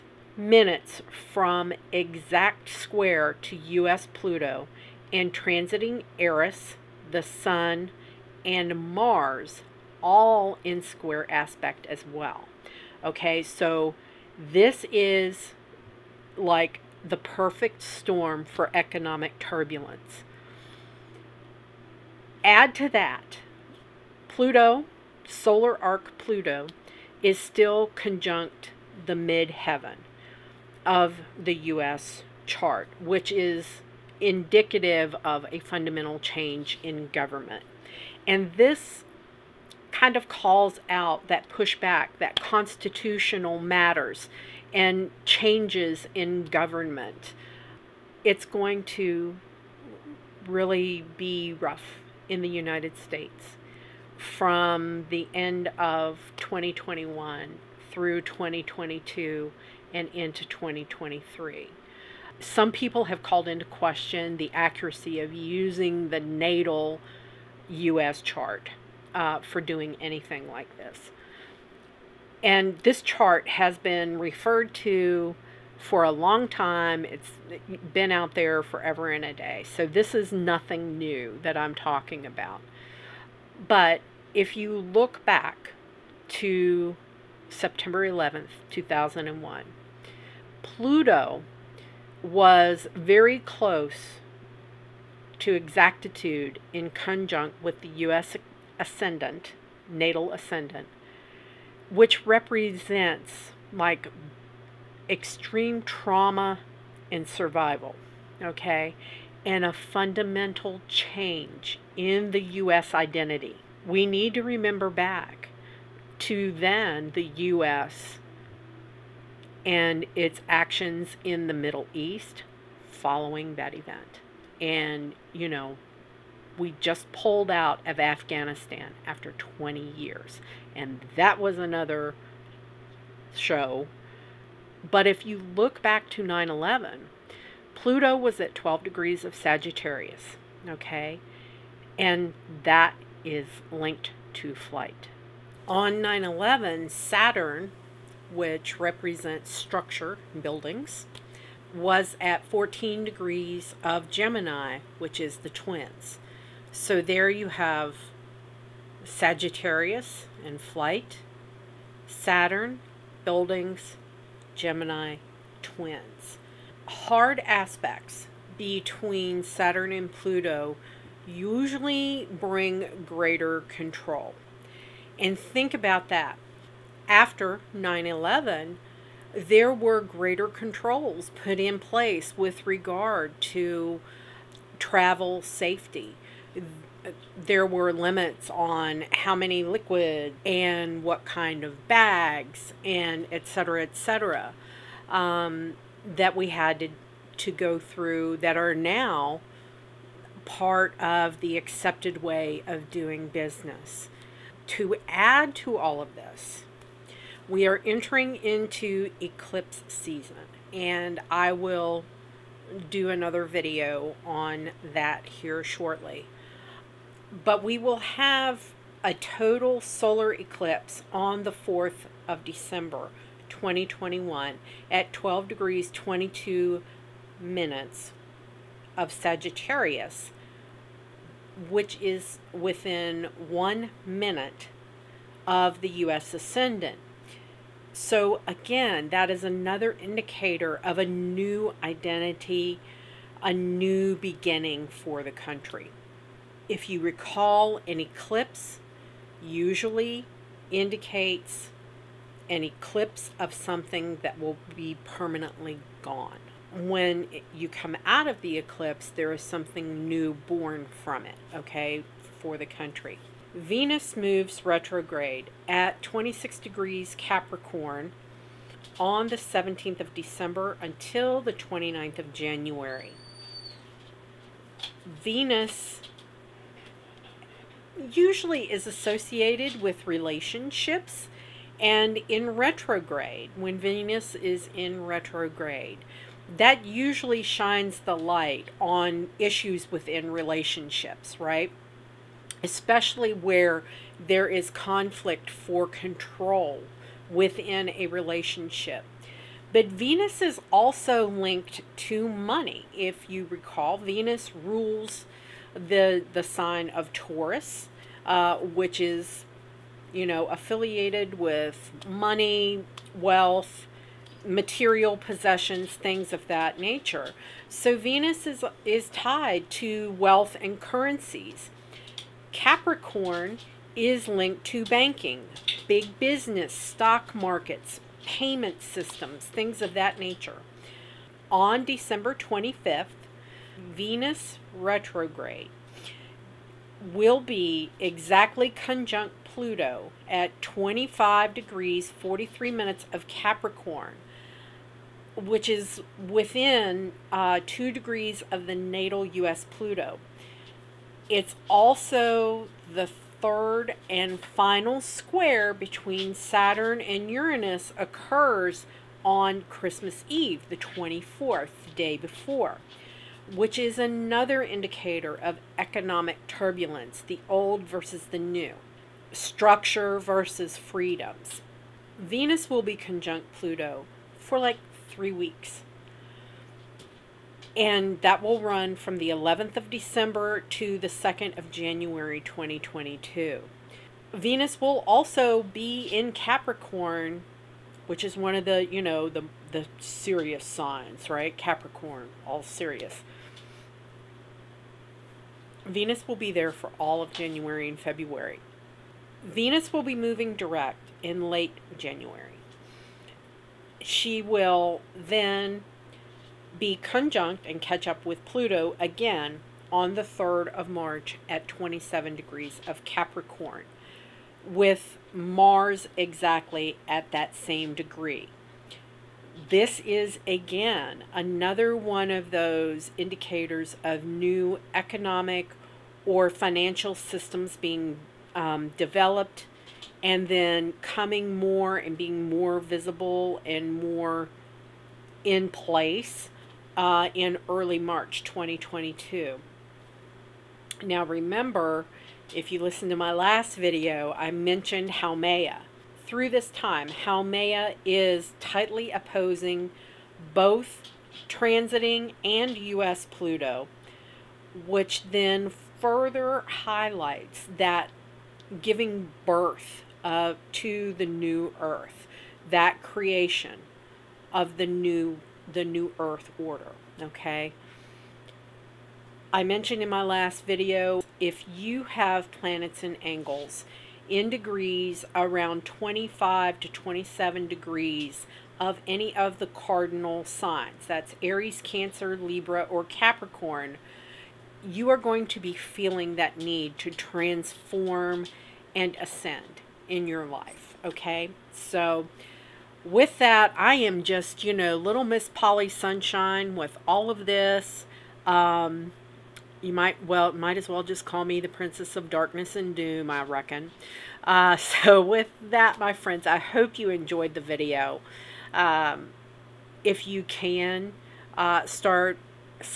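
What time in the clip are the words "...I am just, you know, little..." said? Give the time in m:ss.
8:13.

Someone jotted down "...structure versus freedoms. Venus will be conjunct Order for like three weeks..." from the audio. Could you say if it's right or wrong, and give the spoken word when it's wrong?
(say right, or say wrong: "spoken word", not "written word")
wrong: "Pluto", not "Order".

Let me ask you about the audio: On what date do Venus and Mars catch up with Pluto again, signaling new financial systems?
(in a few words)
March 3.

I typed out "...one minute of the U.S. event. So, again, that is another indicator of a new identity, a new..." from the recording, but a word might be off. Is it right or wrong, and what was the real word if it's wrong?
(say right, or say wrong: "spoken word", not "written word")
wrong: "ascendant", not "event".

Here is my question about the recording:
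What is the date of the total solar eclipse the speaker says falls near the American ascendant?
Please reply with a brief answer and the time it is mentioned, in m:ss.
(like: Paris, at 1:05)
December 4, 2021, at 3:41.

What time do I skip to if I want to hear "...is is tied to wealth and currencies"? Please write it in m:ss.
5:18.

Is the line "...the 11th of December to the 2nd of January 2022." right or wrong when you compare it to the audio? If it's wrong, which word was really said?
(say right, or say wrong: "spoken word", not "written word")
right.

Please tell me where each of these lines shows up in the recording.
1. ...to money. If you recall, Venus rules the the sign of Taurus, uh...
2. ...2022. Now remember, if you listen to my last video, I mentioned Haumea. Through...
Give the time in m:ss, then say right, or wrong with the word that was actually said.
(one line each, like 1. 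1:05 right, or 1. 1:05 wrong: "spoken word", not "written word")
1. 5:01 right
2. 7:18 right.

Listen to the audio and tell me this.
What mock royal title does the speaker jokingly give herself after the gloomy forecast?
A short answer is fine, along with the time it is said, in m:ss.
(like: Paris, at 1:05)
Princess of Darkness and Doom, at 8:21.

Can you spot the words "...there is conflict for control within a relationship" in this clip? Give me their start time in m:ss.
4:54.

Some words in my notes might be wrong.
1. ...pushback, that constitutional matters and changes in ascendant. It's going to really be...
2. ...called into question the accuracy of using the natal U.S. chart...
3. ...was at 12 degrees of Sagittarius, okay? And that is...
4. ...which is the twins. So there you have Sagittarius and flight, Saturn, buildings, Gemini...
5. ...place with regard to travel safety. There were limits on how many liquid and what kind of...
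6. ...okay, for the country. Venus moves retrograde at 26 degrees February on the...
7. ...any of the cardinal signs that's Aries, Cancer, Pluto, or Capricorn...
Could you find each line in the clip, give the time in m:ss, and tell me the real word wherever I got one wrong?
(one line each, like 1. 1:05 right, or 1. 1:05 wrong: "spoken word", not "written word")
1. 0:41 wrong: "government", not "ascendant"
2. 1:03 right
3. 2:18 right
4. 2:34 right
5. 3:01 right
6. 4:21 wrong: "Capricorn", not "February"
7. 7:59 wrong: "Libra", not "Pluto".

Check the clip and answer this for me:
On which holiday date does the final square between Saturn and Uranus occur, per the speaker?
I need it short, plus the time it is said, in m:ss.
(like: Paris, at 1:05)
Christmas Eve, at 5:59.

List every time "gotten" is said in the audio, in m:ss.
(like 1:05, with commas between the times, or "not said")
not said.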